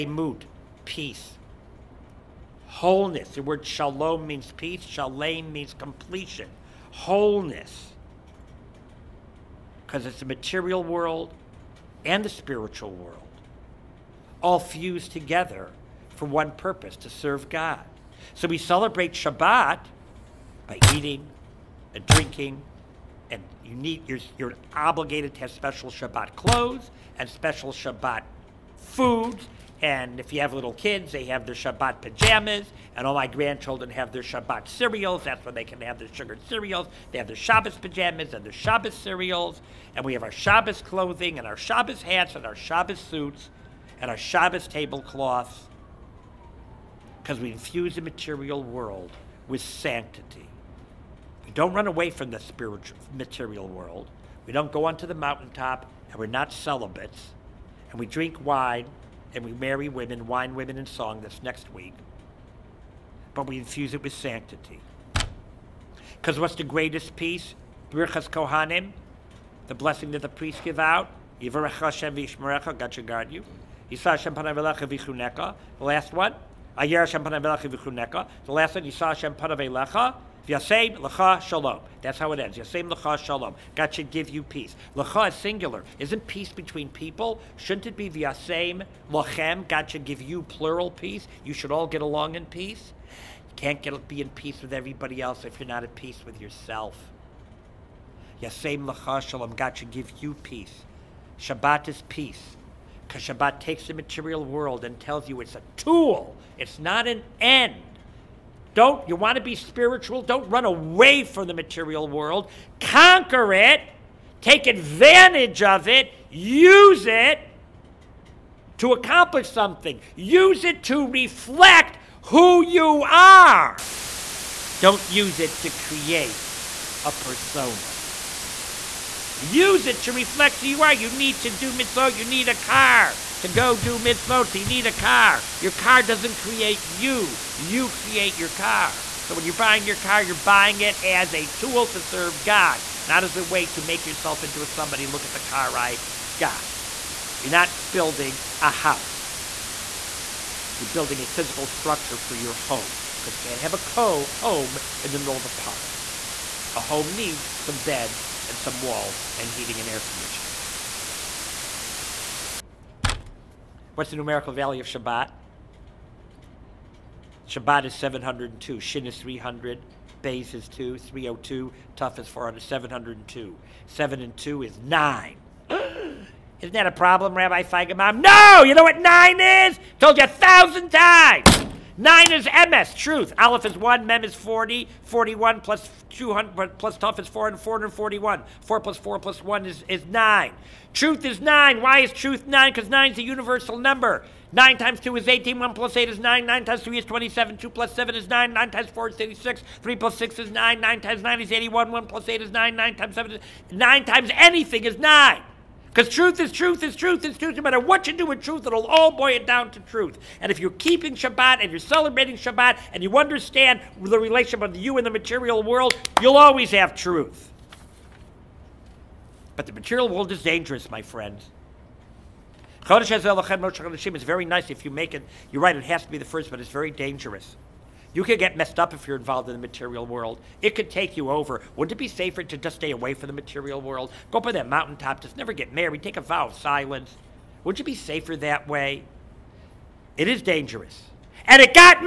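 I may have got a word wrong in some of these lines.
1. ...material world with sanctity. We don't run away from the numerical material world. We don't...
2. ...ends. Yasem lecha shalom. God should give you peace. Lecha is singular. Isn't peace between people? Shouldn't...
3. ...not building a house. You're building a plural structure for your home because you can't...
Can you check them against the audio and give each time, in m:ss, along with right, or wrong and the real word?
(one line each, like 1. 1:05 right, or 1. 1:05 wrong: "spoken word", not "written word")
1. 0:48 wrong: "spiritual", not "numerical"
2. 1:22 right
3. 2:27 wrong: "physical", not "plural".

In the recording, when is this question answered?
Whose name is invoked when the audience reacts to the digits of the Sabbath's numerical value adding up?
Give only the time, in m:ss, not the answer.
2:57.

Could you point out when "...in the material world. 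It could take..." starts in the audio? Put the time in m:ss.
3:49.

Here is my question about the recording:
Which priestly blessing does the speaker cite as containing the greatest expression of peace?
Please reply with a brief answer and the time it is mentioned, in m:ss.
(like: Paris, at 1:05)
Birchas Kohanim, at 1:07.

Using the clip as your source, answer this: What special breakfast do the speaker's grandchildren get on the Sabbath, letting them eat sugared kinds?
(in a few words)
Shabbat cereals.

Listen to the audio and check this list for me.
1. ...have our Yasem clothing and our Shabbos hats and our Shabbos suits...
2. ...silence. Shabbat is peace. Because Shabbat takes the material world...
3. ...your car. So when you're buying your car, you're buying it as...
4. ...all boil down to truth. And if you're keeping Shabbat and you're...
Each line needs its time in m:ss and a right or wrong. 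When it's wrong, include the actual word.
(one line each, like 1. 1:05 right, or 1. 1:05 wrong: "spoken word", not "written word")
1. 0:40 wrong: "Shabbos", not "Yasem"
2. 1:40 wrong: "peace", not "silence"
3. 2:18 right
4. 3:28 right.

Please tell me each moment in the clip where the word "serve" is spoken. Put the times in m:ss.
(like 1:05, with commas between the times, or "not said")
0:17, 2:22.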